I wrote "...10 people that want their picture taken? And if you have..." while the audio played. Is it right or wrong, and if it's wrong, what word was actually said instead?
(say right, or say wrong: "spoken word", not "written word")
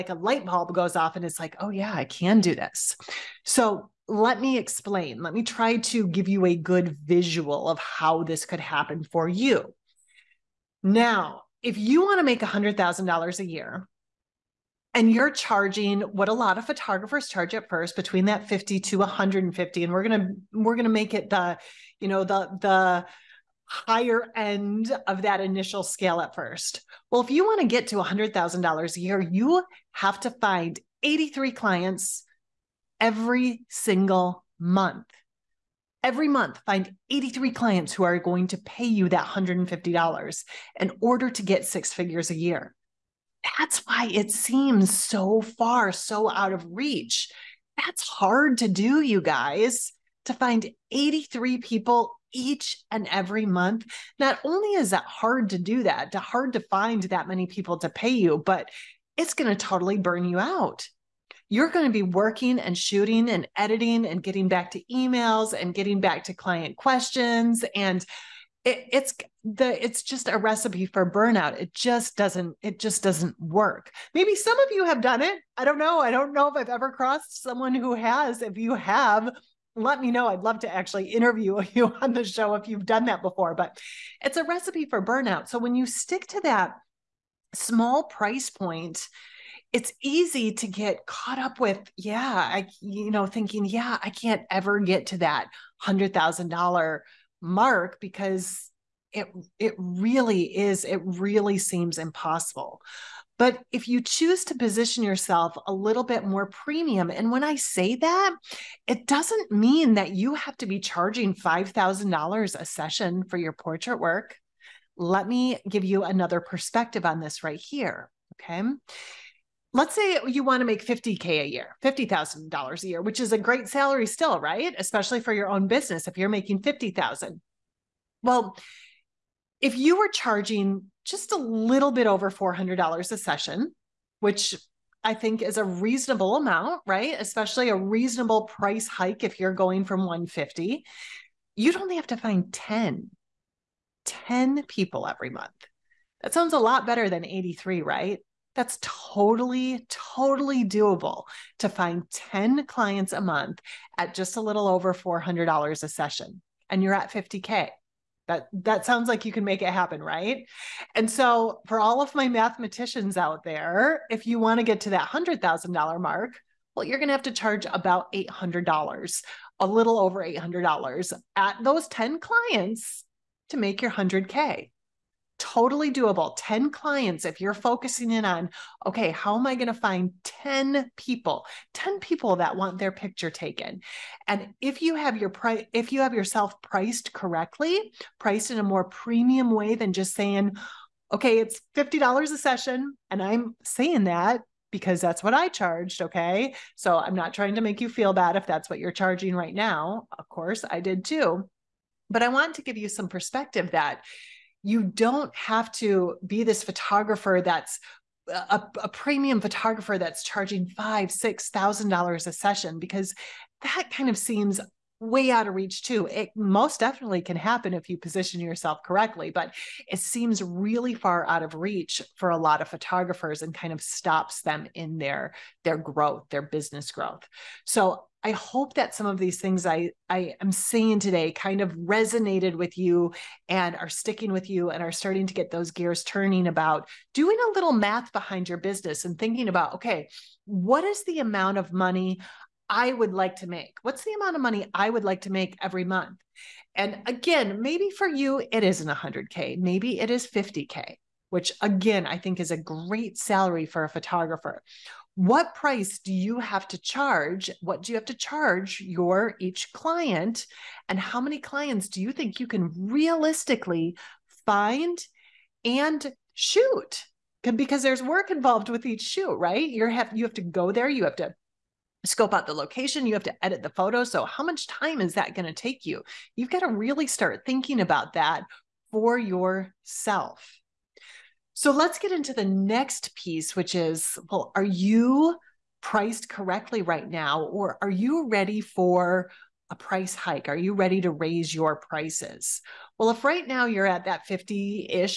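right.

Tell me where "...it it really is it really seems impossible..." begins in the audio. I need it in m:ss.
1:39.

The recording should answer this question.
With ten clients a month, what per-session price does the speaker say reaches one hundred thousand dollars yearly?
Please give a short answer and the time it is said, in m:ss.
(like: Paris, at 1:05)
$800, at 2:49.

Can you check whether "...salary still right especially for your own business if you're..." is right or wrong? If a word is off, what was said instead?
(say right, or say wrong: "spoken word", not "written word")
right.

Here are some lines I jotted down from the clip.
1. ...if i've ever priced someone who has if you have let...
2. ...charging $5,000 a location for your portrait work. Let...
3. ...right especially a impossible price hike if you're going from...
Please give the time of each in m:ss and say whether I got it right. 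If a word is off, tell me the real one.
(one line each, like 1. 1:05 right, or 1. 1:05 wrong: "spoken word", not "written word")
1. 1:16 wrong: "crossed", not "priced"
2. 1:50 wrong: "session", not "location"
3. 2:16 wrong: "reasonable", not "impossible".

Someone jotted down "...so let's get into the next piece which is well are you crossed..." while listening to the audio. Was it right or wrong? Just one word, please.
wrong.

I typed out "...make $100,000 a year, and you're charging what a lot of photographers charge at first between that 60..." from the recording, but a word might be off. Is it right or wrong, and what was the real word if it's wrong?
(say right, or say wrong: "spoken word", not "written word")
wrong: "50", not "60".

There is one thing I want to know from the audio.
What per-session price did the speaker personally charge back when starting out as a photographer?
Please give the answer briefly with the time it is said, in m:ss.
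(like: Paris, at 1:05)
$50, at 3:11.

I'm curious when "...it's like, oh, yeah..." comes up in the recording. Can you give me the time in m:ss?
0:01.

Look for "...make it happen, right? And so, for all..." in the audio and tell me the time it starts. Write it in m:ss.
2:39.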